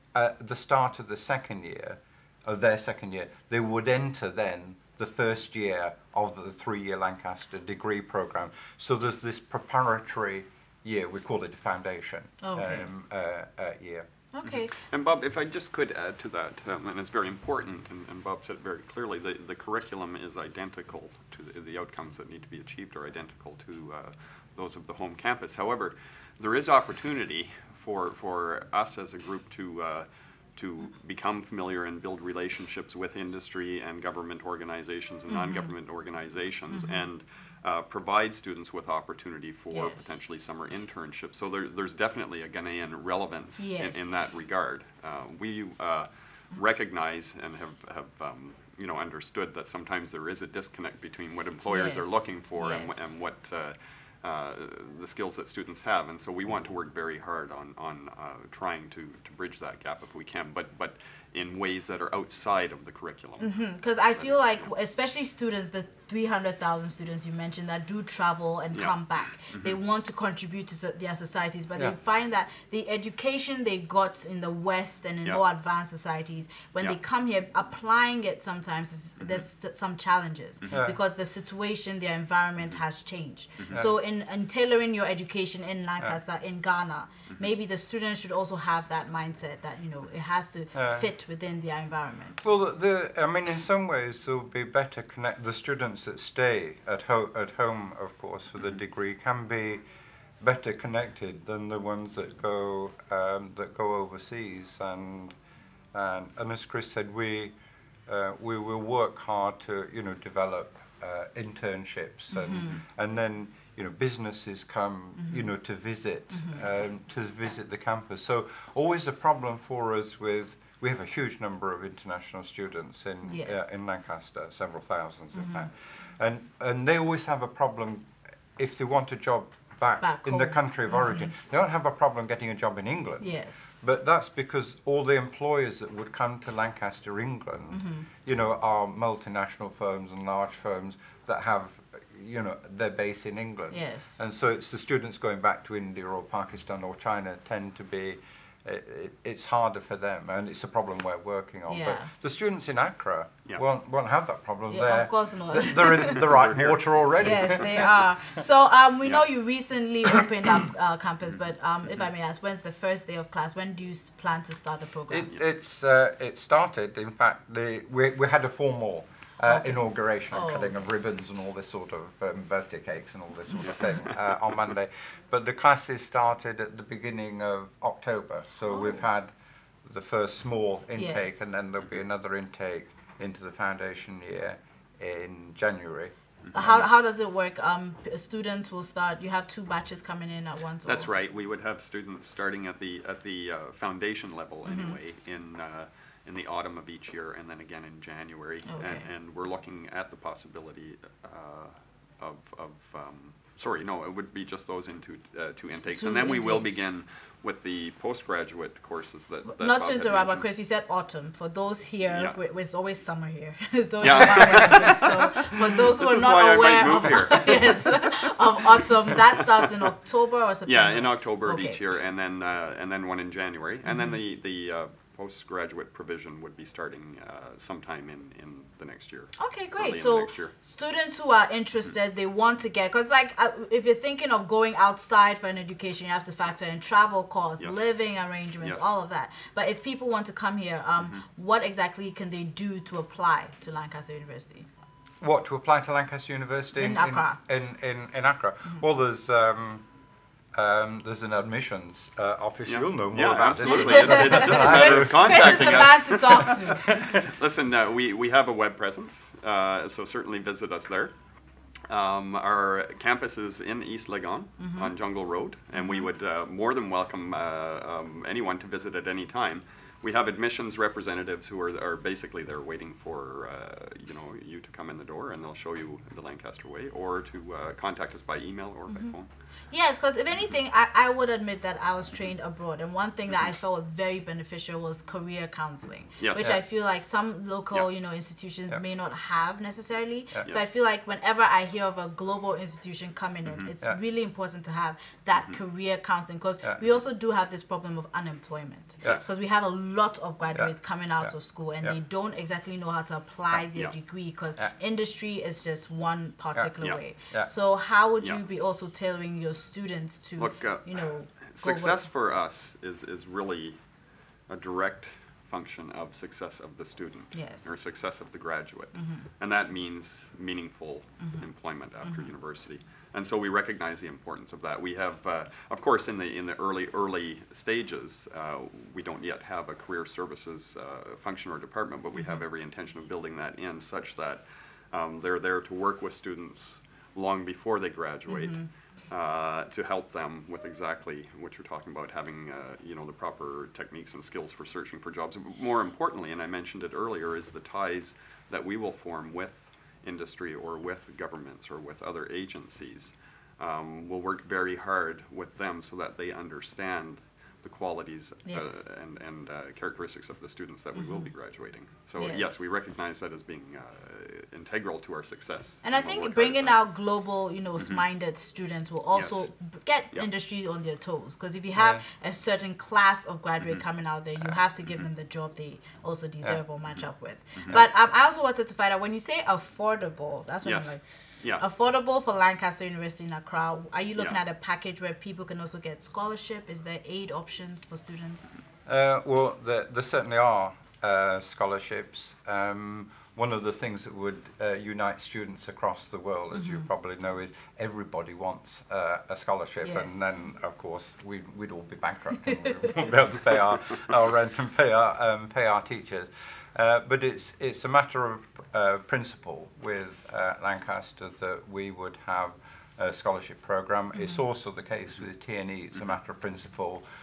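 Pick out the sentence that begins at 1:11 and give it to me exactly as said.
they find that the education they got in the West and in yeah.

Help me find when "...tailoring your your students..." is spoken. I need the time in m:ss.
5:08.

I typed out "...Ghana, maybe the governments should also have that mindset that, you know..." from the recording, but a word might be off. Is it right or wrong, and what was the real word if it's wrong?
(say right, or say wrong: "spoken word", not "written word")
wrong: "students", not "governments".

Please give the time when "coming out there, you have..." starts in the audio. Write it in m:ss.
6:13.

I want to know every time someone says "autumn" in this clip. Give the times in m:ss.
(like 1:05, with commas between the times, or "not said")
3:16, 3:30, 3:38.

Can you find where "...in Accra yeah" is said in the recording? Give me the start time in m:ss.
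2:32.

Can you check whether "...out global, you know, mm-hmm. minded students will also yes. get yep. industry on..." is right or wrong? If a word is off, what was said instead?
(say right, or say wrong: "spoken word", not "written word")
right.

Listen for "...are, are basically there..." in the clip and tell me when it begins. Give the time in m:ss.
4:31.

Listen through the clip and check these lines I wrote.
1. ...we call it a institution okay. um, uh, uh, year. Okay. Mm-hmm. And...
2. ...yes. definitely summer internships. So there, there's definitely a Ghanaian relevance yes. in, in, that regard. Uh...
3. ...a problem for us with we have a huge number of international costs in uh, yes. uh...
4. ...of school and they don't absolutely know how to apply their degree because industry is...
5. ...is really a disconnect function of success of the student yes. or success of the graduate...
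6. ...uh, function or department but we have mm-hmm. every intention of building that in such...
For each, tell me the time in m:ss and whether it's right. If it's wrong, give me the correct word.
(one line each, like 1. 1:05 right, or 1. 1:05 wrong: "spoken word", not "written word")
1. 0:11 wrong: "foundation", not "institution"
2. 0:39 wrong: "potentially", not "definitely"
3. 1:59 wrong: "students", not "costs"
4. 5:01 wrong: "exactly", not "absolutely"
5. 5:13 wrong: "direct", not "disconnect"
6. 5:30 right.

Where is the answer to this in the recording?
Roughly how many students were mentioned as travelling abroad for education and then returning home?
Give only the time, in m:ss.
1:06.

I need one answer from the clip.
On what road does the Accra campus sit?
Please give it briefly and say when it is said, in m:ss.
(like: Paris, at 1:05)
Jungle Road, at 4:24.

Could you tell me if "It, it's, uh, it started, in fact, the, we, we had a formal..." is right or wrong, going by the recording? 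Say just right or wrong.
right.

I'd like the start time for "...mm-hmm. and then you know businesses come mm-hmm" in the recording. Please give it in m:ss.
1:52.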